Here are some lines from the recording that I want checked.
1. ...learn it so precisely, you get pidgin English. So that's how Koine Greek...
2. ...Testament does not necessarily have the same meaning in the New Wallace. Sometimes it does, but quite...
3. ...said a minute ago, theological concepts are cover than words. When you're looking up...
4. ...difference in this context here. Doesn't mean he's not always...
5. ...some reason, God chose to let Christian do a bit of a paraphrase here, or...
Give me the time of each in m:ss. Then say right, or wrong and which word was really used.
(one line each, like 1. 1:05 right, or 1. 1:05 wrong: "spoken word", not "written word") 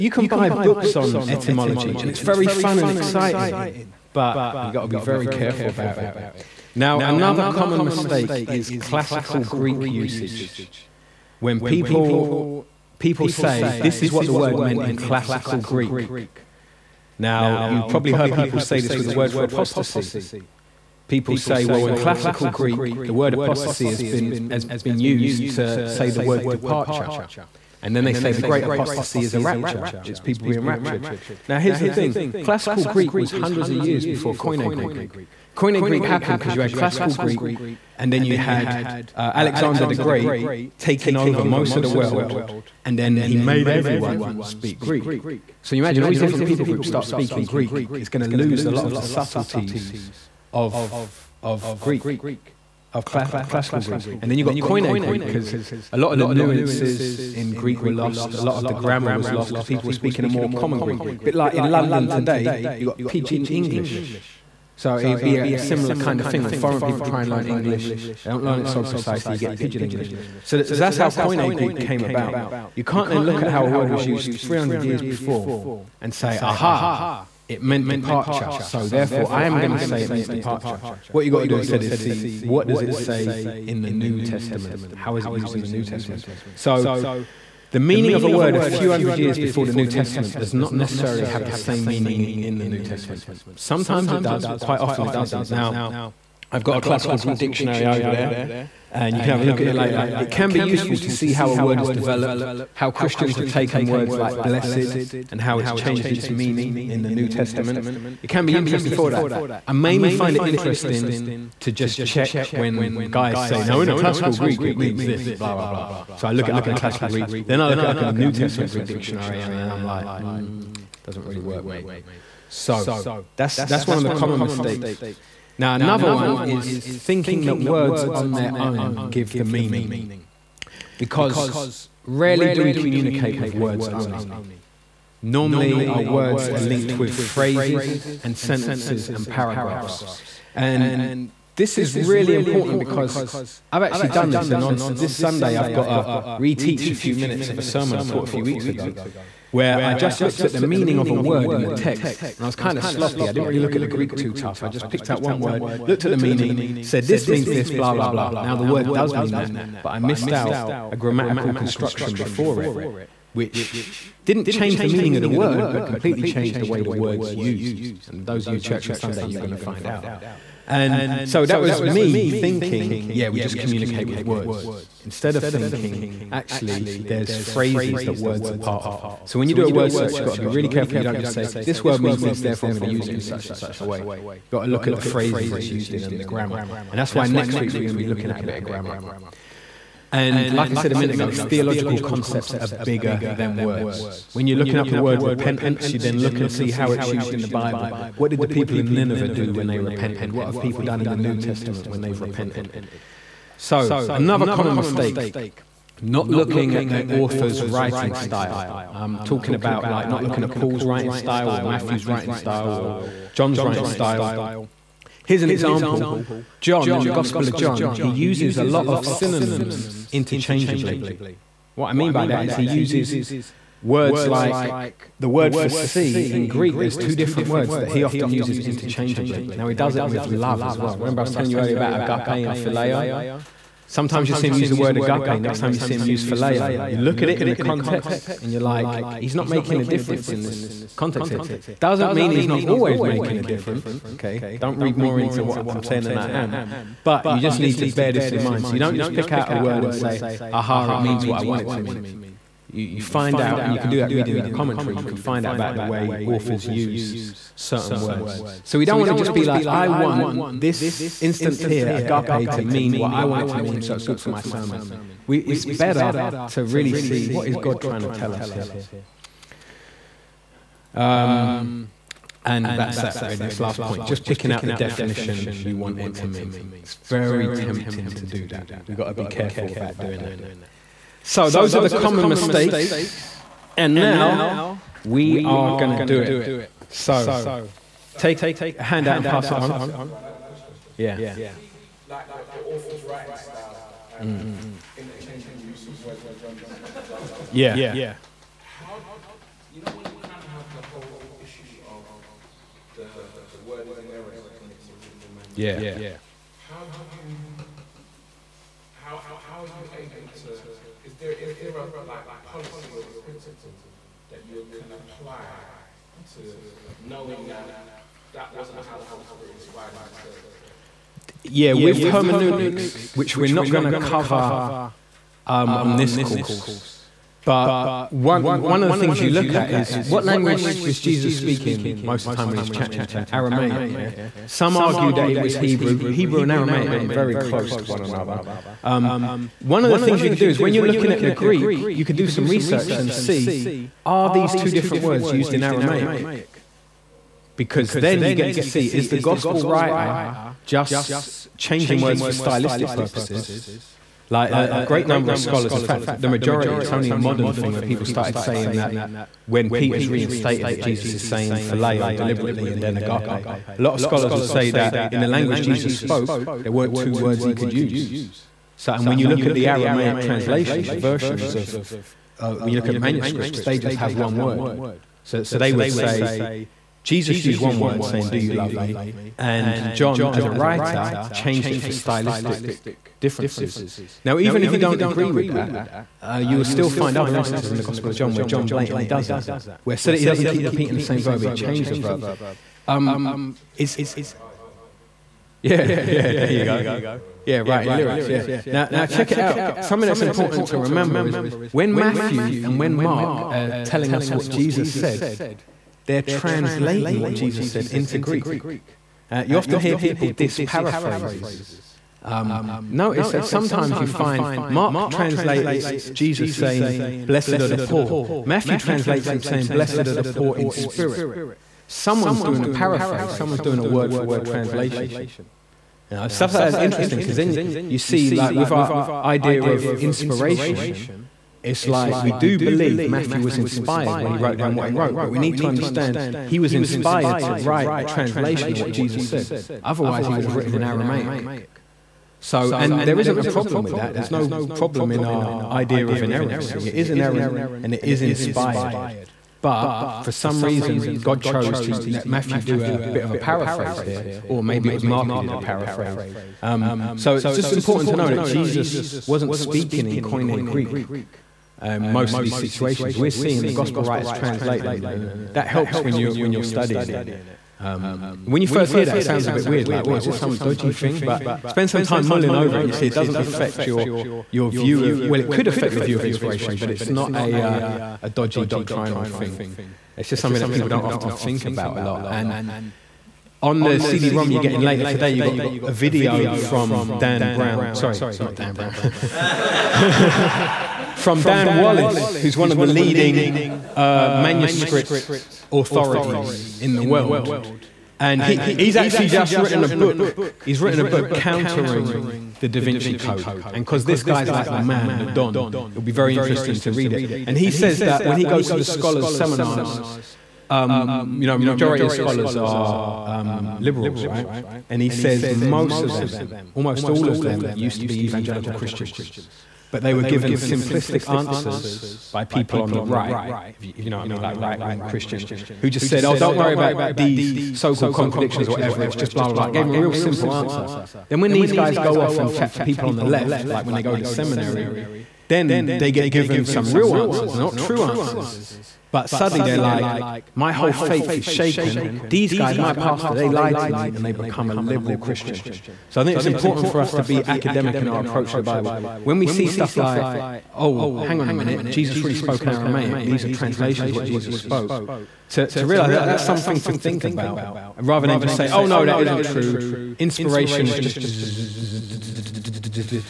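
1. 1:08 right
2. 1:29 wrong: "Testament", not "Wallace"
3. 3:10 wrong: "bigger", not "cover"
4. 3:59 right
5. 7:30 wrong: "Matthew", not "Christian".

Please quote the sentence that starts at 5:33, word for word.
Yeah, some argue that it was Hebrew.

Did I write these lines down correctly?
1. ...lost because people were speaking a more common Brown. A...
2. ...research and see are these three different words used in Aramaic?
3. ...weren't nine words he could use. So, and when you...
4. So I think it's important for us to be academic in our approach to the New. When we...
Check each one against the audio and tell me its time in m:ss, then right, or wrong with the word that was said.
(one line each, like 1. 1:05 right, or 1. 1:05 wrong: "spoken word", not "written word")
1. 0:59 wrong: "Greek", not "Brown"
2. 5:42 wrong: "two", not "three"
3. 6:06 wrong: "two", not "nine"
4. 9:06 wrong: "Bible", not "New".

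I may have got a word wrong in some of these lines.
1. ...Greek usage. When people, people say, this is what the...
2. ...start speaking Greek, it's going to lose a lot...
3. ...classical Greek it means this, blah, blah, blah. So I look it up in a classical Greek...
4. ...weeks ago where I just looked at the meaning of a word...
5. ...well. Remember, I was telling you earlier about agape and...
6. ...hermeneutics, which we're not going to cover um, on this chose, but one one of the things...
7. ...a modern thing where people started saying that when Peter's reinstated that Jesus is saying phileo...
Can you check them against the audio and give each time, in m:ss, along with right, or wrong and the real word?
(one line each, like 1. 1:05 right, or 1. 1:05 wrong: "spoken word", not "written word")
1. 0:09 right
2. 0:46 right
3. 1:53 right
4. 2:28 right
5. 3:50 right
6. 5:22 wrong: "course", not "chose"
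7. 5:57 right.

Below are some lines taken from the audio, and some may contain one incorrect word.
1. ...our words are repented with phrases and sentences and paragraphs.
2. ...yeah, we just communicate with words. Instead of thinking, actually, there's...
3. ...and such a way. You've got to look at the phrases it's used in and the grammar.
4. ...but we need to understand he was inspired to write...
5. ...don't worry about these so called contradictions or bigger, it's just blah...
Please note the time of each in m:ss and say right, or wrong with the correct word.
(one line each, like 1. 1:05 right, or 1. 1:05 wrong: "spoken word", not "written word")
1. 2:15 wrong: "linked", not "repented"
2. 2:53 right
3. 3:03 right
4. 7:15 right
5. 8:46 wrong: "whatever", not "bigger".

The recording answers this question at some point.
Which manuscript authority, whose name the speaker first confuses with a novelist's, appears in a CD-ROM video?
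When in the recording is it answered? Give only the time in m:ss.
8:11.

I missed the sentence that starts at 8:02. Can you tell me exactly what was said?
And on the CD-ROM you're getting later today, you got a video from Dan Brown.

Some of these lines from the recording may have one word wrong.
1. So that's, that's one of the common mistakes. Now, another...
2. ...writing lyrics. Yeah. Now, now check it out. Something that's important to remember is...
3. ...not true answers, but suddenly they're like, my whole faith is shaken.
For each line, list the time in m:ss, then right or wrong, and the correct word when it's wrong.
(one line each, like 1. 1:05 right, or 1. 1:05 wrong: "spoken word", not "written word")
1. 2:02 right
2. 6:37 right
3. 8:57 right.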